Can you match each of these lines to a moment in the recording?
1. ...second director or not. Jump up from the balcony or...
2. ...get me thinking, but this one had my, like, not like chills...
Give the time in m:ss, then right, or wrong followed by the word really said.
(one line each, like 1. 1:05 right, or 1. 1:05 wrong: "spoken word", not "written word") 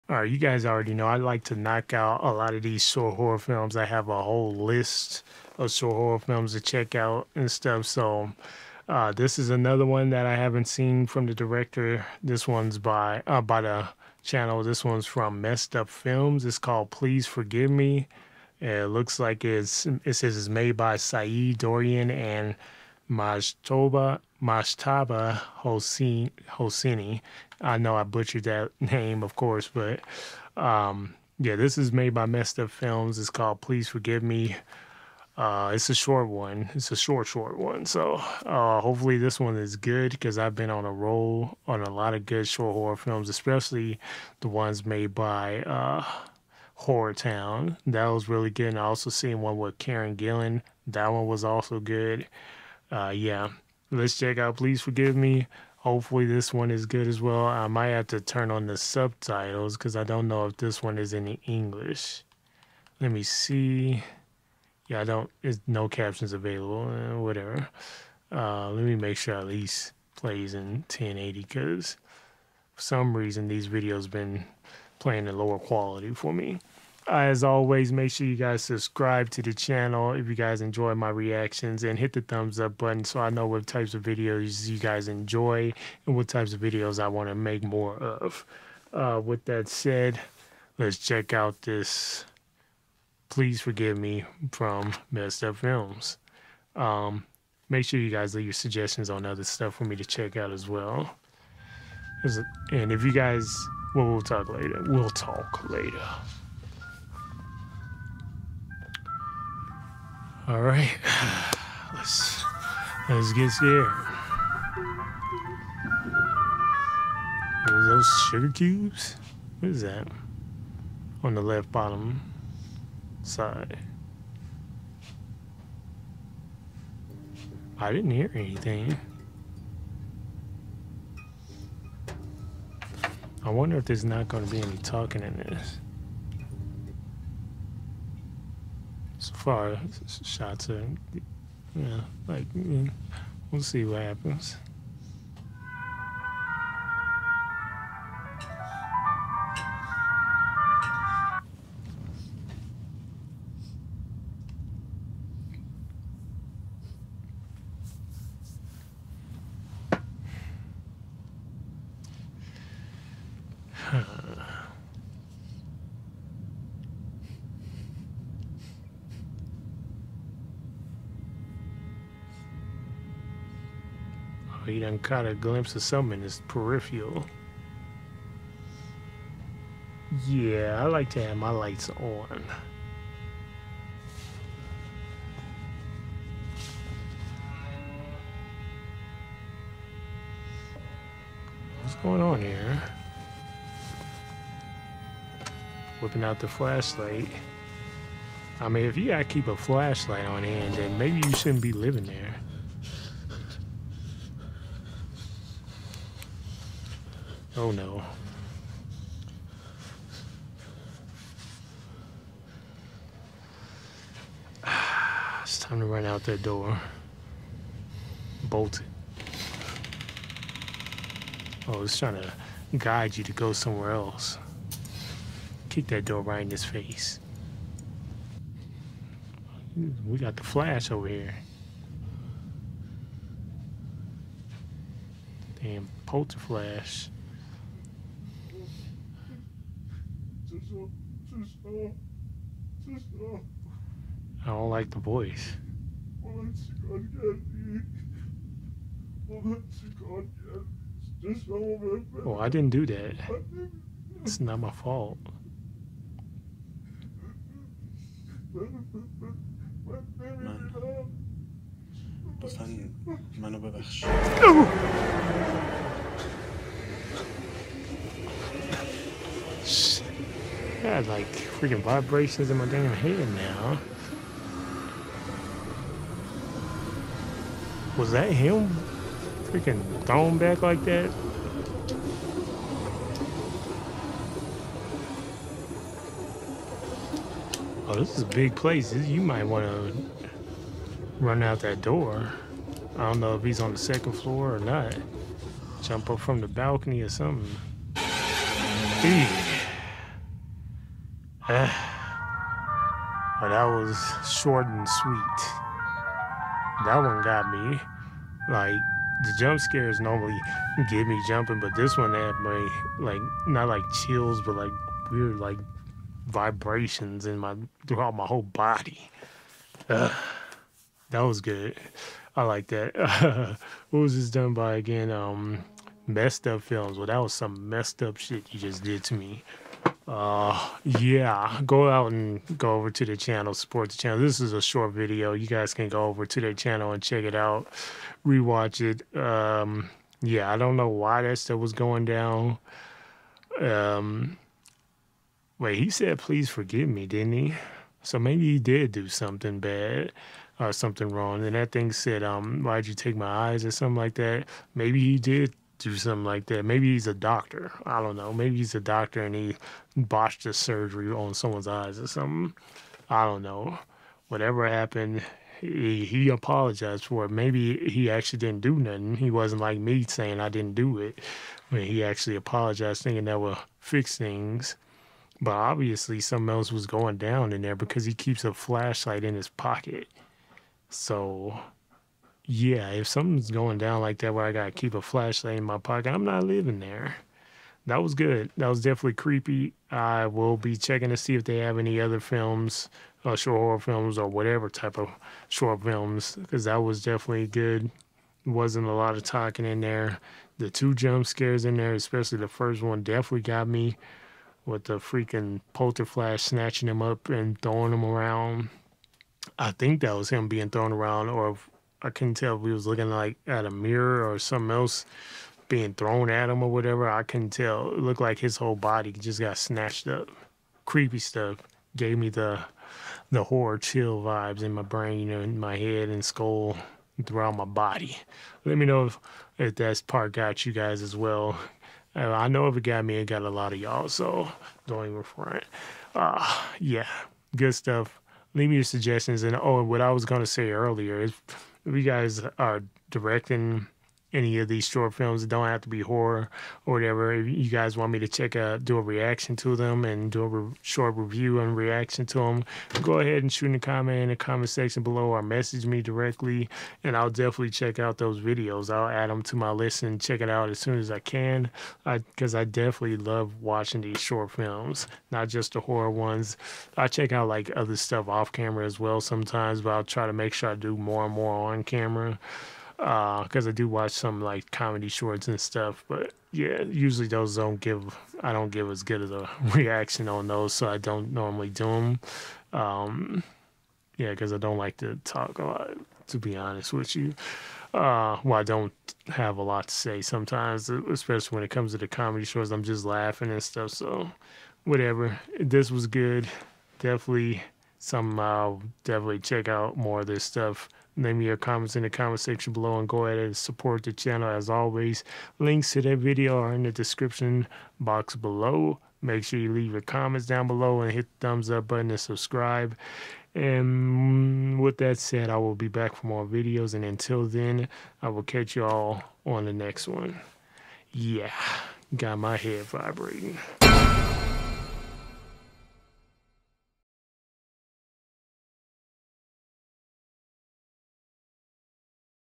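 1. 4:53 wrong: "floor", not "director"
2. 5:10 wrong: "jumping", not "thinking".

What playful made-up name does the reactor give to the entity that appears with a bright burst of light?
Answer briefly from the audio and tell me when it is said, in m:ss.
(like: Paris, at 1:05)
polter flash, at 3:56.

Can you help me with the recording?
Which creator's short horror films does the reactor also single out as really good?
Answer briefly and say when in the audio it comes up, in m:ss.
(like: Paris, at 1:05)
Horror Town, at 0:46.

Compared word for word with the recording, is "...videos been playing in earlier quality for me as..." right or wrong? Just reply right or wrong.
wrong.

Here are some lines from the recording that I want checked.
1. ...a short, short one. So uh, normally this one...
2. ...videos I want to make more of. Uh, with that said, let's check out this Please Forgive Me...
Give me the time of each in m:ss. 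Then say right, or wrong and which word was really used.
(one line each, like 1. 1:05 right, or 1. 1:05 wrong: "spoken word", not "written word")
1. 0:36 wrong: "hopefully", not "normally"
2. 1:26 right.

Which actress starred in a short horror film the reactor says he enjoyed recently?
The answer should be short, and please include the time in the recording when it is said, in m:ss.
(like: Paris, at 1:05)
Karen Gillan, at 0:49.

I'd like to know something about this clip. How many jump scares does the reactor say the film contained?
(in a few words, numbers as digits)
2.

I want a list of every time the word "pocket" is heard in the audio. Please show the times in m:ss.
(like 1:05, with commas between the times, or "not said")
6:19, 6:25.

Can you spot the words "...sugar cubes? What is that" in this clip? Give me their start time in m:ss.
1:58.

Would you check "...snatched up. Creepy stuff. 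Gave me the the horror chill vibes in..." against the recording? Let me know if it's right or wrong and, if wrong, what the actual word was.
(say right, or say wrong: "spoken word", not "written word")
right.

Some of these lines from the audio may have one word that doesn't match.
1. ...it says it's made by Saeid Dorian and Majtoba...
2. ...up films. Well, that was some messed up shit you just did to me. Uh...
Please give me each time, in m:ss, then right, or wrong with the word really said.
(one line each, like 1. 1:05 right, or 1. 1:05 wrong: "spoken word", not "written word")
1. 0:20 right
2. 5:26 right.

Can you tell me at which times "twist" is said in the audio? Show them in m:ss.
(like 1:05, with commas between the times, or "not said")
not said.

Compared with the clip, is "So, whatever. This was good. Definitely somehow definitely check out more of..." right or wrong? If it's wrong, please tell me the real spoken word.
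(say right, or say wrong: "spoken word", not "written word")
right.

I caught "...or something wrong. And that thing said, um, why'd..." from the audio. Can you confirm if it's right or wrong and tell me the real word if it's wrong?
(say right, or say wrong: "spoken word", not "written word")
right.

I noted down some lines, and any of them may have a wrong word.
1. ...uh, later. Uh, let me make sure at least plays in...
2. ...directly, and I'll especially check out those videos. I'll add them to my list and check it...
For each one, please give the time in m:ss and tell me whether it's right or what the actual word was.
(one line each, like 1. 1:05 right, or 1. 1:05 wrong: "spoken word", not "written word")
1. 1:06 wrong: "whatever", not "later"
2. 7:36 wrong: "definitely", not "especially".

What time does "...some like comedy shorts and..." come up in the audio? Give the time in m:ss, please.
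7:54.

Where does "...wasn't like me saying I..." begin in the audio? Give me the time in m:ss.
6:09.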